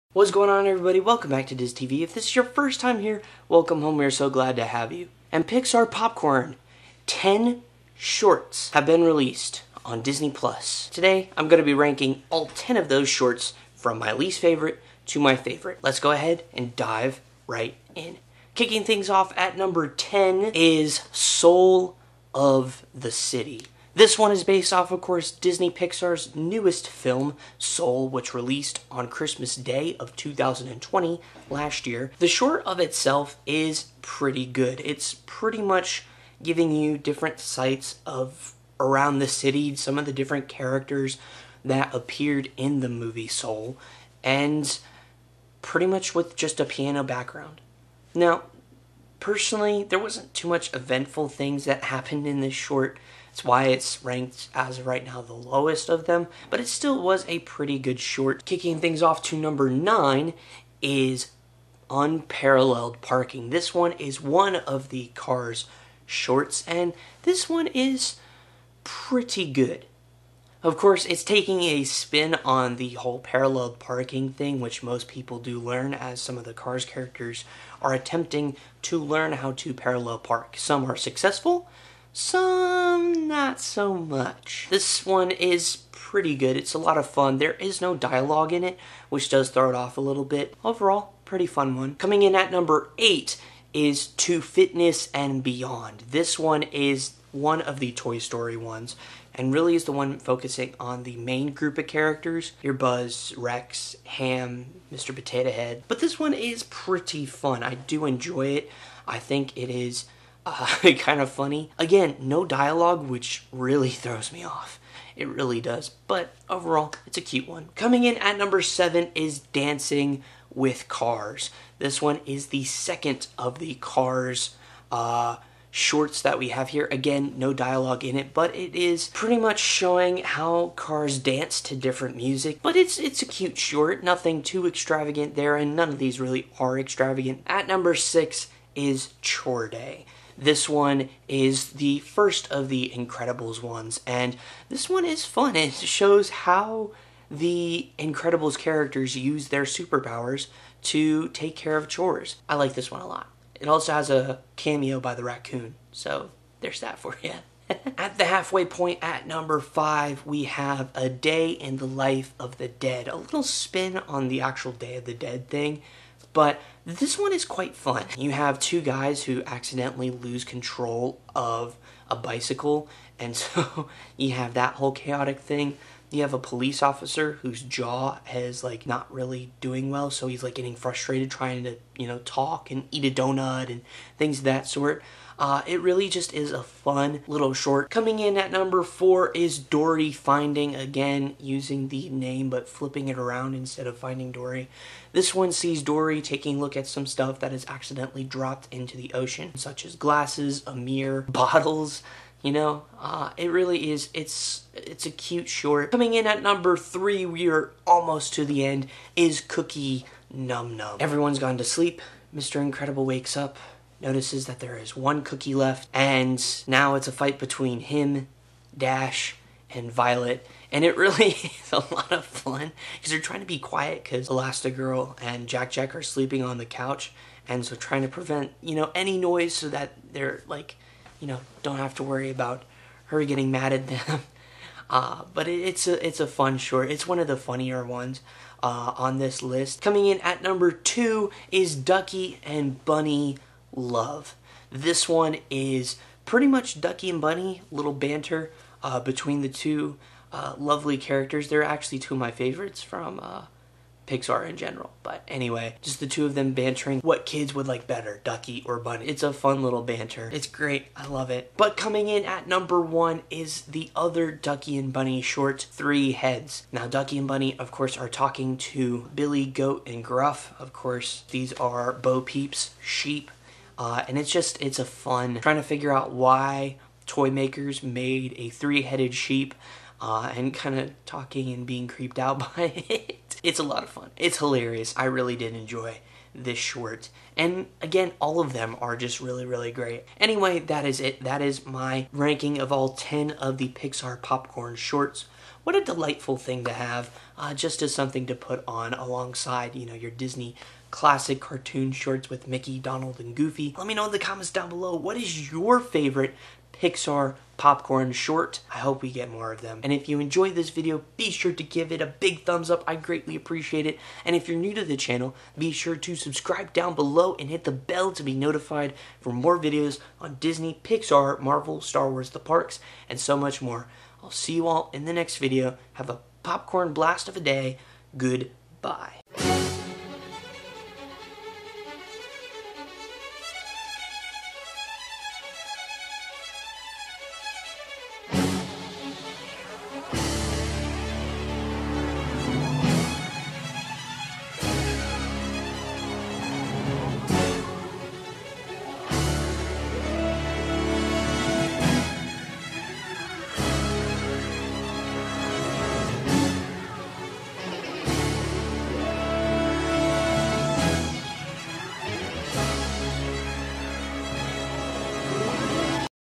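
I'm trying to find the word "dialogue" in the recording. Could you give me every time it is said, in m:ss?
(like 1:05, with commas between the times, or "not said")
1:27, 1:52, 2:07.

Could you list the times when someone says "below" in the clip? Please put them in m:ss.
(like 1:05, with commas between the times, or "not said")
5:04, 5:16.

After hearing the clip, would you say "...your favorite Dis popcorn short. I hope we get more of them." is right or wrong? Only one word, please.
wrong.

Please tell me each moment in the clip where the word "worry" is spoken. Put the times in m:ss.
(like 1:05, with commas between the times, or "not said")
3:52.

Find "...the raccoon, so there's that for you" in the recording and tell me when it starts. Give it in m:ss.
2:35.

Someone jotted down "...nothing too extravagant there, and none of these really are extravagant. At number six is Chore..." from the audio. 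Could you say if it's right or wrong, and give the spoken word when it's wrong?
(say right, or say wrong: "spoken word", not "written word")
right.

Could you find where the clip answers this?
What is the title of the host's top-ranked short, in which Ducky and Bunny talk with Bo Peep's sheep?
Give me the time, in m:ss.
4:25.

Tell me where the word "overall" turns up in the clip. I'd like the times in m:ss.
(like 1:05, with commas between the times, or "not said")
1:30, 1:56.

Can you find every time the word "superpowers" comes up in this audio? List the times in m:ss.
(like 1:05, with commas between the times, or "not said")
2:29.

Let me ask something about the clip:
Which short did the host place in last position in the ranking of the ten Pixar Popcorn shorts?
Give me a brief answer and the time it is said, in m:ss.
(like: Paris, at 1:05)
Soul of the City, at 0:21.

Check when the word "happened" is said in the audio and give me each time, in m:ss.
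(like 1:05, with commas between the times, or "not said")
0:51.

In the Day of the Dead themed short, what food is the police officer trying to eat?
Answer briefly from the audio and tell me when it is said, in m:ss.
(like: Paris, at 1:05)
donut, at 3:03.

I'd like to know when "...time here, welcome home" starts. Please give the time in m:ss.
0:02.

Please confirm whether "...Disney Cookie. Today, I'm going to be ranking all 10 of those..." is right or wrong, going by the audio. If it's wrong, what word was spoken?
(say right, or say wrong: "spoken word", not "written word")
wrong: "Plus", not "Cookie".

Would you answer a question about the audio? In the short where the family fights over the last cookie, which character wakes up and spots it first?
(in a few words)
Mr. Incredible.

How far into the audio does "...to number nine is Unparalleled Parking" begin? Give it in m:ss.
0:59.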